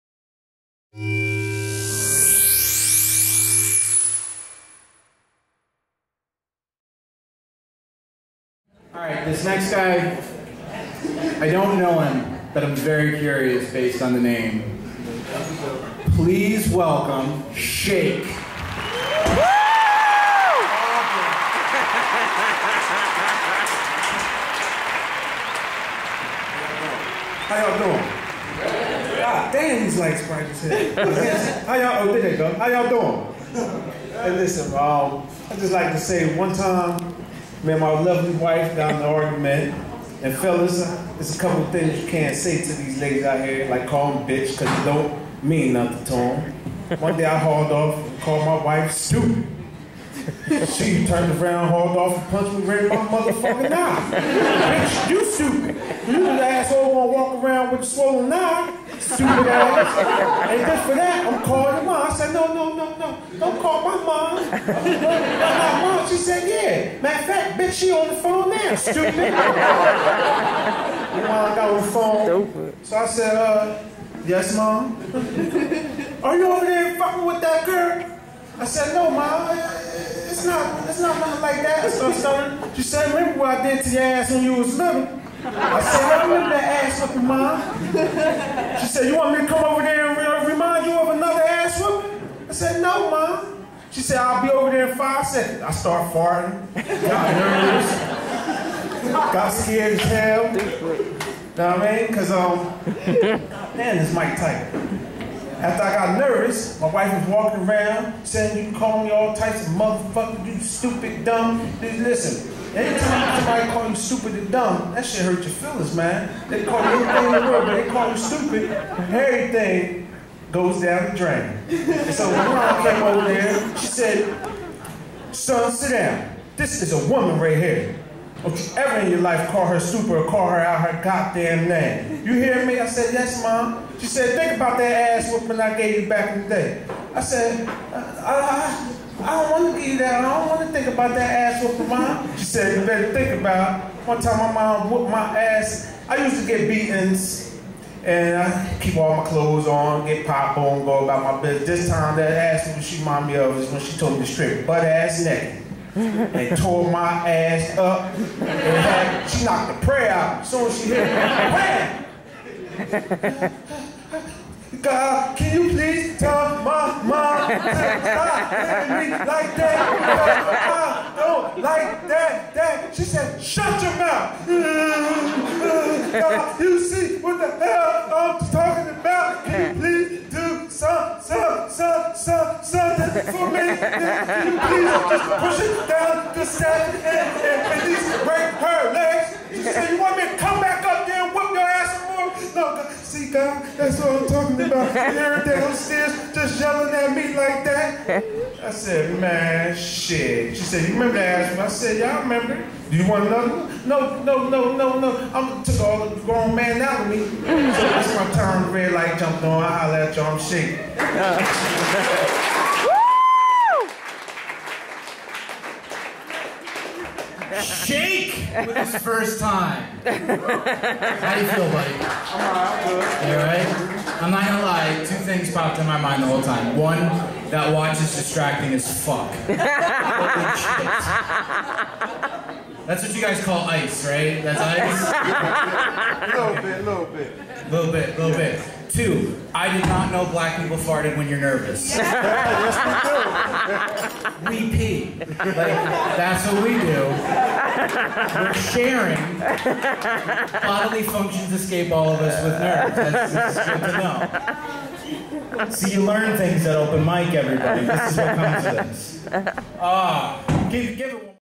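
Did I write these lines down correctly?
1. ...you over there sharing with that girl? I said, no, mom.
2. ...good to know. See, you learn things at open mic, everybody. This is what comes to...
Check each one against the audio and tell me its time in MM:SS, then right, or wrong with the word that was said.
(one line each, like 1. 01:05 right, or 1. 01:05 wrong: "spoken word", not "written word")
1. 01:16 wrong: "fucking", not "sharing"
2. 04:13 right.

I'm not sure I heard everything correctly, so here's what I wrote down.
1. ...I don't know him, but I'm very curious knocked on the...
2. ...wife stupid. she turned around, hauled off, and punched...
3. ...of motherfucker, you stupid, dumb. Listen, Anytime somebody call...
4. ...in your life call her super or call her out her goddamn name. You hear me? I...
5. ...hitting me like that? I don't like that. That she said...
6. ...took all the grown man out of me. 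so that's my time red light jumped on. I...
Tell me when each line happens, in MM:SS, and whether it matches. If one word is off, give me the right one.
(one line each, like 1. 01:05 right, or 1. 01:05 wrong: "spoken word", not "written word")
1. 00:11 wrong: "based", not "knocked"
2. 00:48 right
3. 01:49 right
4. 02:09 right
5. 02:48 right
6. 03:25 right.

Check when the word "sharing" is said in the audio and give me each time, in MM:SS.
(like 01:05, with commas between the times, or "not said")
04:08.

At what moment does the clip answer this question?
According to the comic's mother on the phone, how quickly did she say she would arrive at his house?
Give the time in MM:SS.
01:34.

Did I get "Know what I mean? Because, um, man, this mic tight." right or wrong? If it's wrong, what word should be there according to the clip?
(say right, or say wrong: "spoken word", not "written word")
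right.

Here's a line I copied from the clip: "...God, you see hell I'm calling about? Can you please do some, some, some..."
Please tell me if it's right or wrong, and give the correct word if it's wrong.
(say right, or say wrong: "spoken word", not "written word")
wrong: "talking", not "calling".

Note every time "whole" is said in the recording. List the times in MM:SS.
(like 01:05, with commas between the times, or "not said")
03:46.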